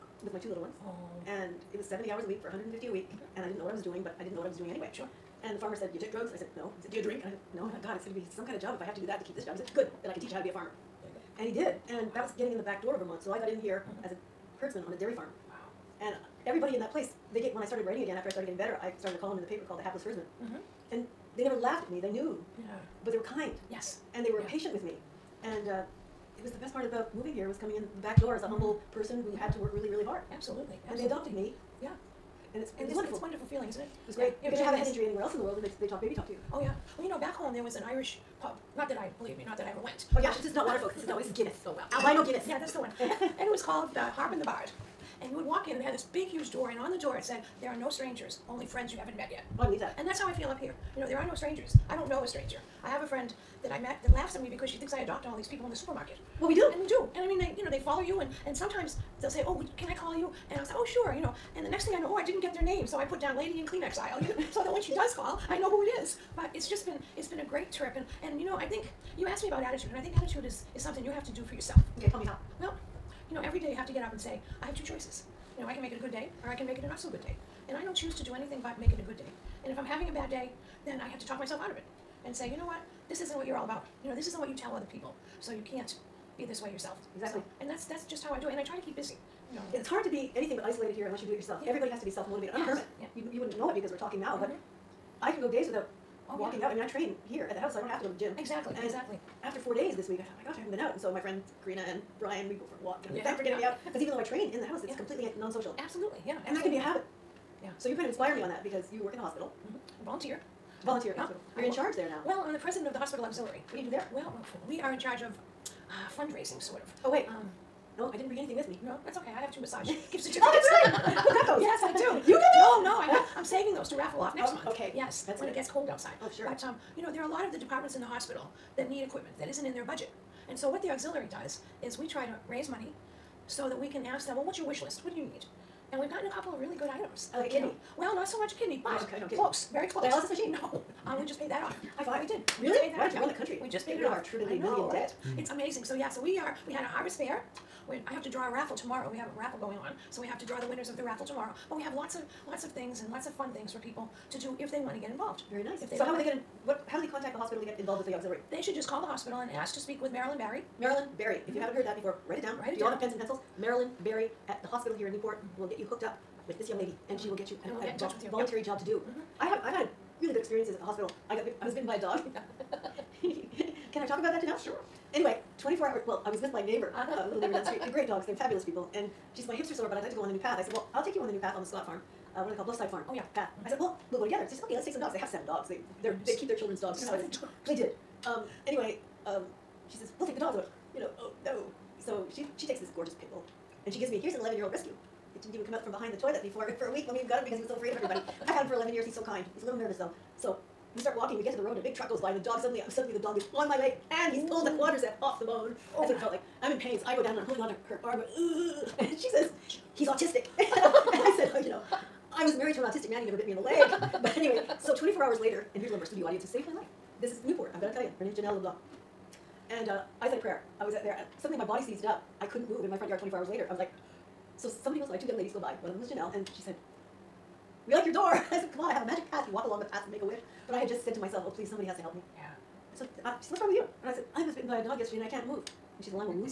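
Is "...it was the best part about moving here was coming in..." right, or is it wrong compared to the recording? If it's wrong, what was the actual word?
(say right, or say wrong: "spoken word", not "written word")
right.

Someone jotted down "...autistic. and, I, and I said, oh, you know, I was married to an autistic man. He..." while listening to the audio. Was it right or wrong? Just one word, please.
right.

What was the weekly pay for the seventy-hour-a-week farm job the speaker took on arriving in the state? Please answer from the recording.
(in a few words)
150.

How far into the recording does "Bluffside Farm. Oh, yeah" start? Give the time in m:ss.
3:02.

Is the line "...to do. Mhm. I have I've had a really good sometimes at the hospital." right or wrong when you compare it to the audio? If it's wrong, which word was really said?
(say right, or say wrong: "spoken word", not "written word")
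wrong: "experiences", not "sometimes".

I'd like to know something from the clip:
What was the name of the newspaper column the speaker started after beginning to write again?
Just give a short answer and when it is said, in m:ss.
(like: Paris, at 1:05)
The Hapless Herdsman, at 0:19.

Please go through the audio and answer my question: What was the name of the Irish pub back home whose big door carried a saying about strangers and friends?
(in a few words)
The Harp and the Bard.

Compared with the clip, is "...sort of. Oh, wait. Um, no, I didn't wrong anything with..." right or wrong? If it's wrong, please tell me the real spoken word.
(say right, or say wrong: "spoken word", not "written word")
wrong: "bring", not "wrong".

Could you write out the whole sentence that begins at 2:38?
They should just call the hospital and ask to speak with Marilyn Barry.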